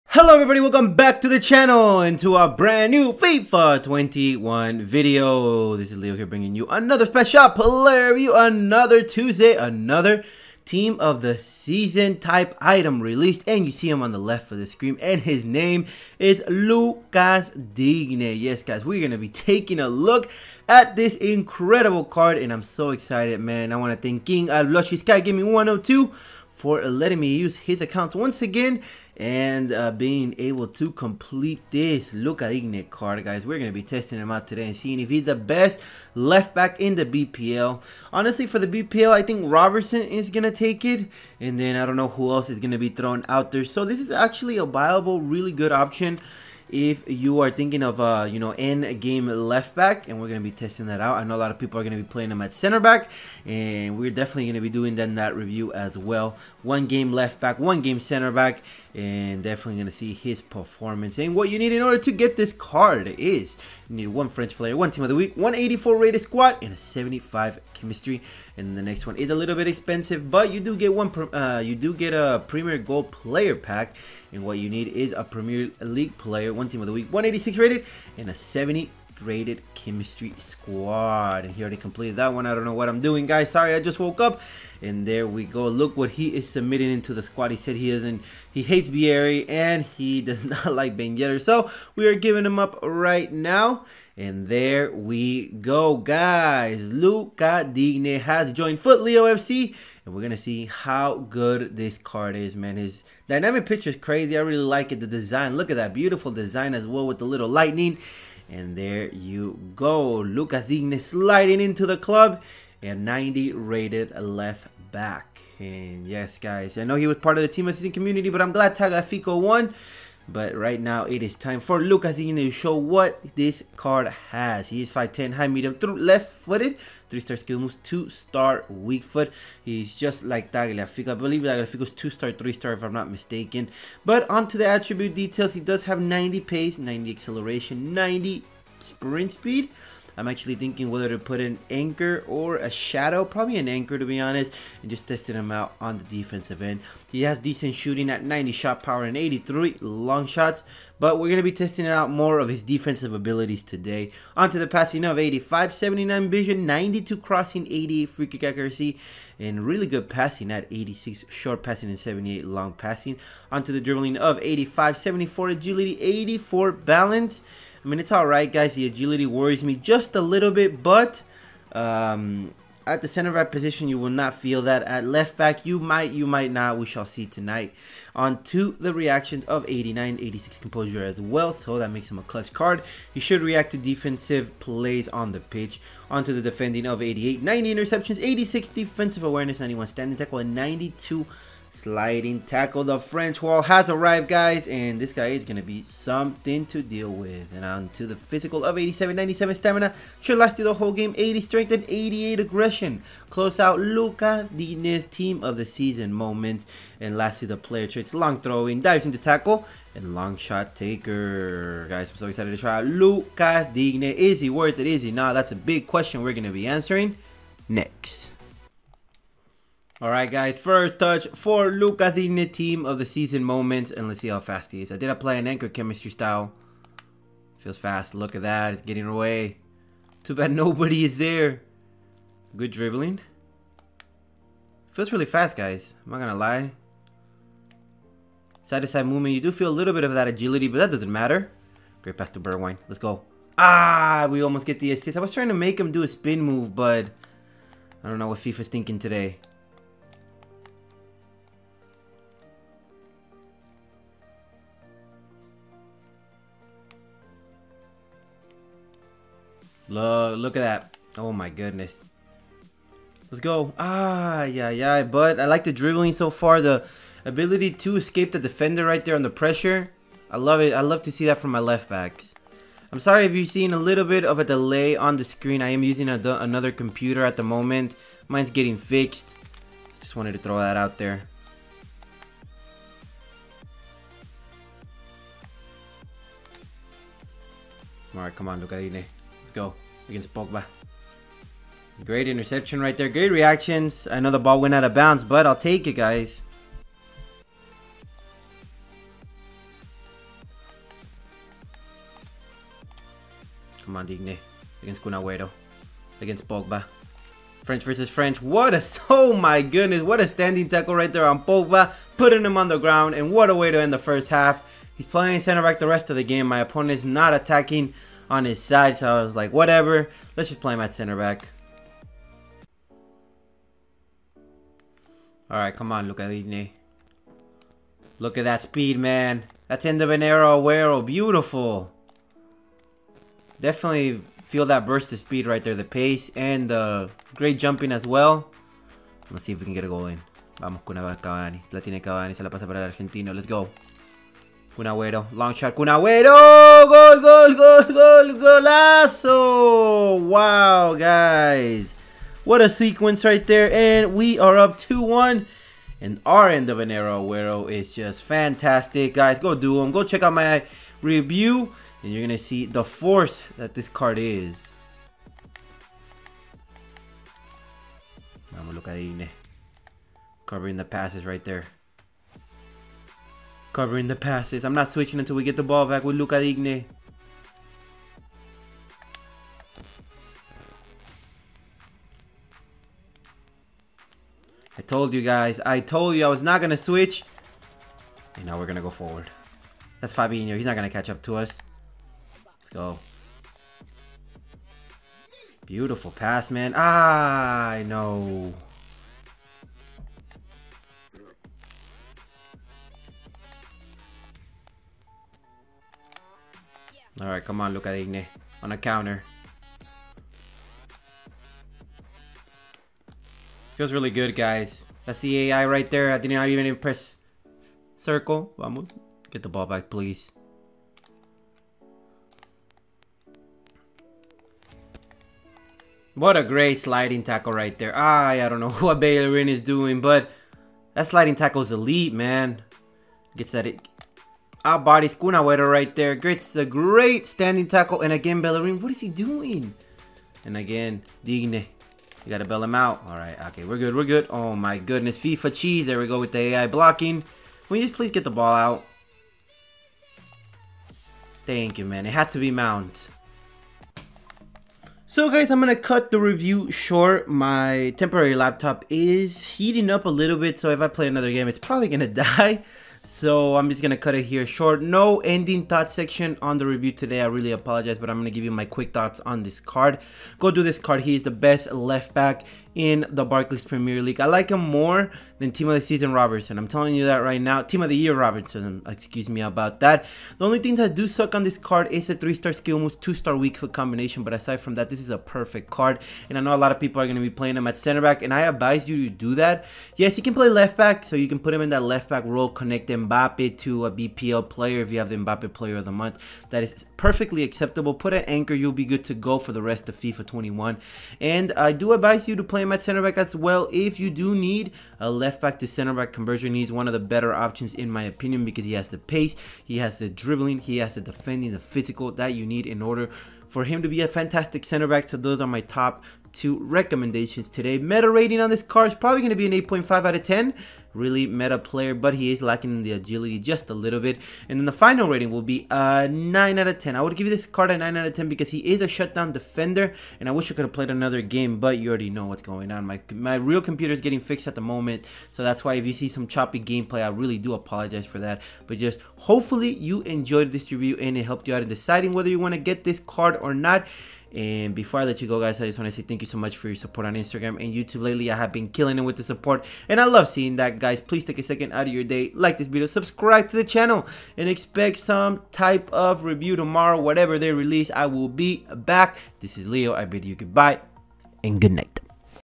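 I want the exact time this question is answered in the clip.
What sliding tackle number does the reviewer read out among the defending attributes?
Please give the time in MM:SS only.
03:10.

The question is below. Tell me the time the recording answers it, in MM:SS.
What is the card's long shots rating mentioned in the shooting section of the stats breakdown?
02:29.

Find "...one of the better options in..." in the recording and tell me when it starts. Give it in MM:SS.
08:26.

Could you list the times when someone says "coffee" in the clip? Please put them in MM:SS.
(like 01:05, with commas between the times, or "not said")
not said.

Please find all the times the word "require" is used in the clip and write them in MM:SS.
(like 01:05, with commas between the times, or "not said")
not said.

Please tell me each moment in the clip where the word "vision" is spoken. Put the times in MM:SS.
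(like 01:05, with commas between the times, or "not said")
02:36.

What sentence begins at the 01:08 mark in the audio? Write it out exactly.
And the next one is a little bit expensive, but you do get one.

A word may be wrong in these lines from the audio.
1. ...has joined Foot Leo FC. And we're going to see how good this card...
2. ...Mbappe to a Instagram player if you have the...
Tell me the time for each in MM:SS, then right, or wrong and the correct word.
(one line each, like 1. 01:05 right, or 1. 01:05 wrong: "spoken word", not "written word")
1. 01:38 right
2. 08:12 wrong: "BPL", not "Instagram".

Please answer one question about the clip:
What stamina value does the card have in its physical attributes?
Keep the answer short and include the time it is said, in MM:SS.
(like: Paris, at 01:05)
97, at 03:19.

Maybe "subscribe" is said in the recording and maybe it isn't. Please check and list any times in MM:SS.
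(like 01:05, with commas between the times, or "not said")
09:12.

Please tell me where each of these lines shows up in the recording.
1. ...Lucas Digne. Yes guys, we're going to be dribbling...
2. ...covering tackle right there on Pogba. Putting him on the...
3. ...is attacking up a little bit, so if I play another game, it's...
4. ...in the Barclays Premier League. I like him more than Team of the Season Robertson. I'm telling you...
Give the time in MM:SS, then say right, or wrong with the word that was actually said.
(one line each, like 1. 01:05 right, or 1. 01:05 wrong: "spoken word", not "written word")
1. 00:16 wrong: "taking", not "dribbling"
2. 05:10 wrong: "standing", not "covering"
3. 07:38 wrong: "heating", not "attacking"
4. 07:52 right.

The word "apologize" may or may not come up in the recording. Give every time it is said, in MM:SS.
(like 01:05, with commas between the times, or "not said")
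07:47, 08:57.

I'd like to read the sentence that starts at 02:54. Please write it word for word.
At left back, you might, you might not.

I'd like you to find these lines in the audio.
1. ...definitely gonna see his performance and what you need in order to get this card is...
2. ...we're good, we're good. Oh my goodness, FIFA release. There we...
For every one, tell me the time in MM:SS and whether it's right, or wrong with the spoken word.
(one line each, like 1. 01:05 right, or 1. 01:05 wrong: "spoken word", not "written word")
1. 00:59 right
2. 07:23 wrong: "cheese", not "release".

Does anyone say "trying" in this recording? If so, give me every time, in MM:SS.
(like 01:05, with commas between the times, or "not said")
04:05.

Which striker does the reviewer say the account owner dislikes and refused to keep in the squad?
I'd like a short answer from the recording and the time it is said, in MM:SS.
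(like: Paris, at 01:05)
Ben Yedder, at 01:30.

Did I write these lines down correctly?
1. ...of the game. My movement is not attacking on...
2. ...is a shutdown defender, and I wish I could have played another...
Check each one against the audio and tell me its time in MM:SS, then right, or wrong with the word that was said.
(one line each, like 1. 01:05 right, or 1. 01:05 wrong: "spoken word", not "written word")
1. 05:16 wrong: "opponent", not "movement"
2. 08:48 right.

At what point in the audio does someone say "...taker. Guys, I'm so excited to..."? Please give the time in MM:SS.
03:30.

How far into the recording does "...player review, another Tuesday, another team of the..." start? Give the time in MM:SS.
00:07.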